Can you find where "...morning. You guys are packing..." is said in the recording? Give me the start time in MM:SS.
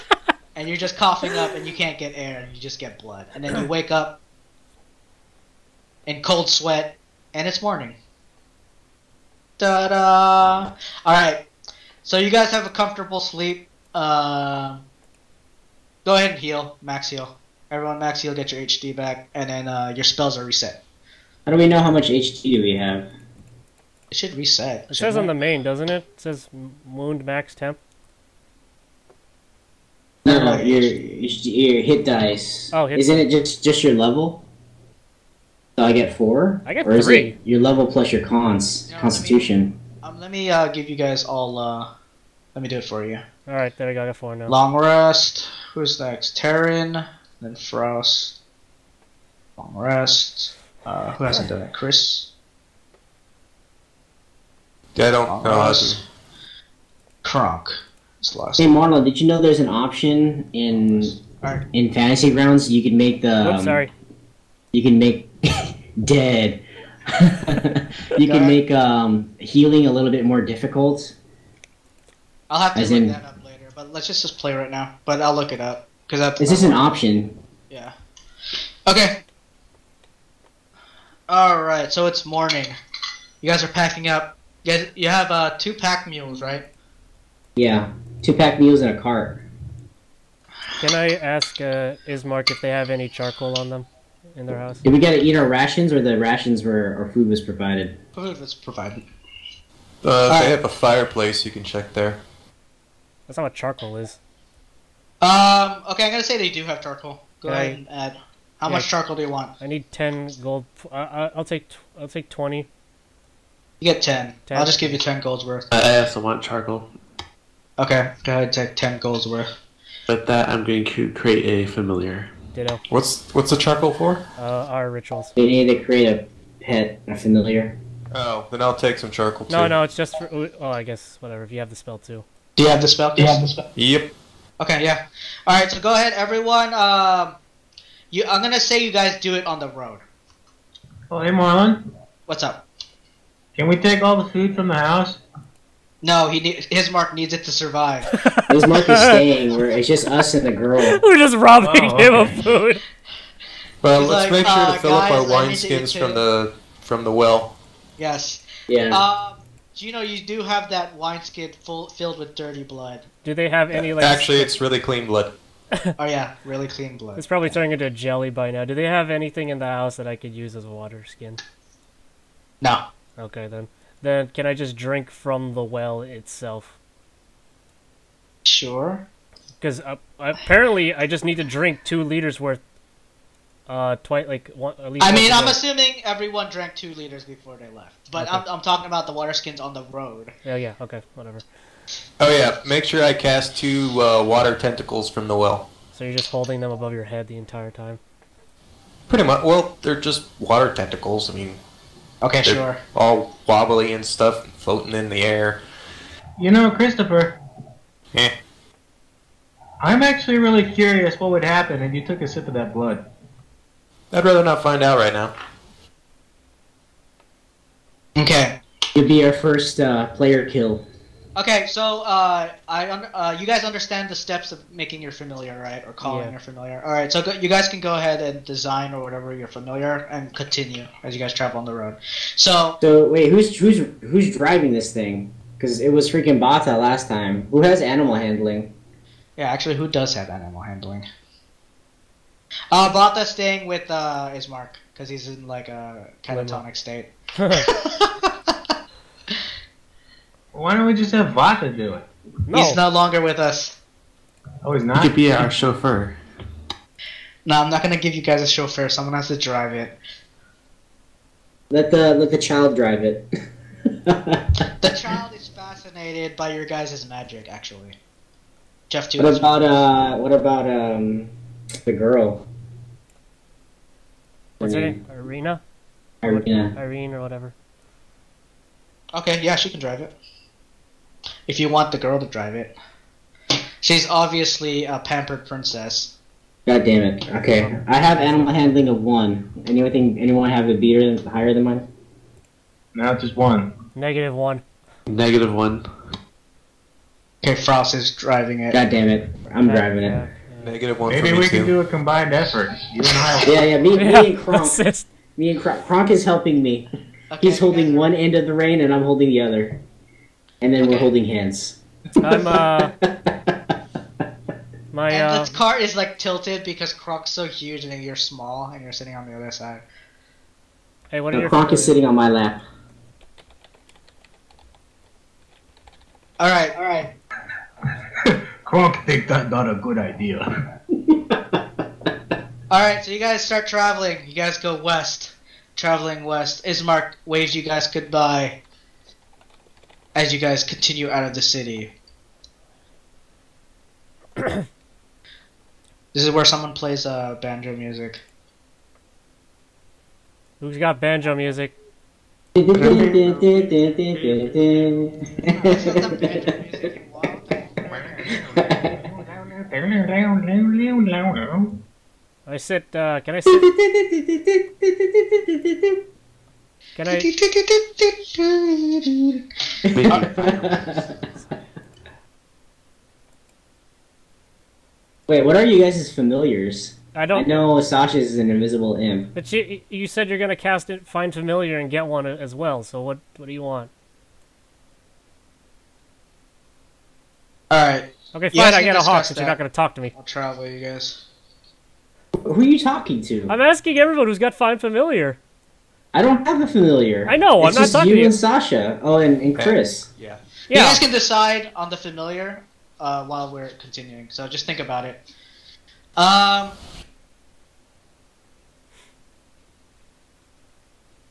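01:22.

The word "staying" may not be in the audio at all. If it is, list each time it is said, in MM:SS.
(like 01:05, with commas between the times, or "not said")
02:28, 04:03.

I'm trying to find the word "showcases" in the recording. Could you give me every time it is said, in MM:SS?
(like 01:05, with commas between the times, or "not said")
not said.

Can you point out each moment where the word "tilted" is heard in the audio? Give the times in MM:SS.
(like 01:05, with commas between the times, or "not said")
05:16.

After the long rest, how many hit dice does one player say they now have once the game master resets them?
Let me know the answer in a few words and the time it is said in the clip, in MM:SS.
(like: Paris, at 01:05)
4, at 00:44.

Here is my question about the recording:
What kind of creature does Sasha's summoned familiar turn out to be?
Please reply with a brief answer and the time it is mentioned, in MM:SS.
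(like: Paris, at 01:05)
invisible imp, at 06:18.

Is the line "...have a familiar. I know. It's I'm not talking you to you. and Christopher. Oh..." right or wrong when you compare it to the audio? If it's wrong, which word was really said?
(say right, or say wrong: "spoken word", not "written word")
wrong: "Sasha", not "Christopher".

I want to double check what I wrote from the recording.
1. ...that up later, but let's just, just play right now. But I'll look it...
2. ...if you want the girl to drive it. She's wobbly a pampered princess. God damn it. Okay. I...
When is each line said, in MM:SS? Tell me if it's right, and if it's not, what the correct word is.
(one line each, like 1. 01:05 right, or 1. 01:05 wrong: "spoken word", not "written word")
1. 01:13 right
2. 04:41 wrong: "obviously", not "wobbly".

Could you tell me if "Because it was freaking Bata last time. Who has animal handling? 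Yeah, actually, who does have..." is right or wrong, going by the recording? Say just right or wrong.
right.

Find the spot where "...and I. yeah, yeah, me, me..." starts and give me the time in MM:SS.
05:03.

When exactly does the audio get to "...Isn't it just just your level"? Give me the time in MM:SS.
00:32.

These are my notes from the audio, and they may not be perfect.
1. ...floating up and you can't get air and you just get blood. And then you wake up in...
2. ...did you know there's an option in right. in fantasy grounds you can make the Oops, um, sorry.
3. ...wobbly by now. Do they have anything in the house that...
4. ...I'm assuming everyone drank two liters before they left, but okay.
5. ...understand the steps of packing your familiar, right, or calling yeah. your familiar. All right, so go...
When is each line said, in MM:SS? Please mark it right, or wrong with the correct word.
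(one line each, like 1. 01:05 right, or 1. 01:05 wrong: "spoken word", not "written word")
1. 00:00 wrong: "coughing", not "floating"
2. 00:59 right
3. 02:47 wrong: "jelly", not "wobbly"
4. 03:05 right
5. 03:43 wrong: "making", not "packing".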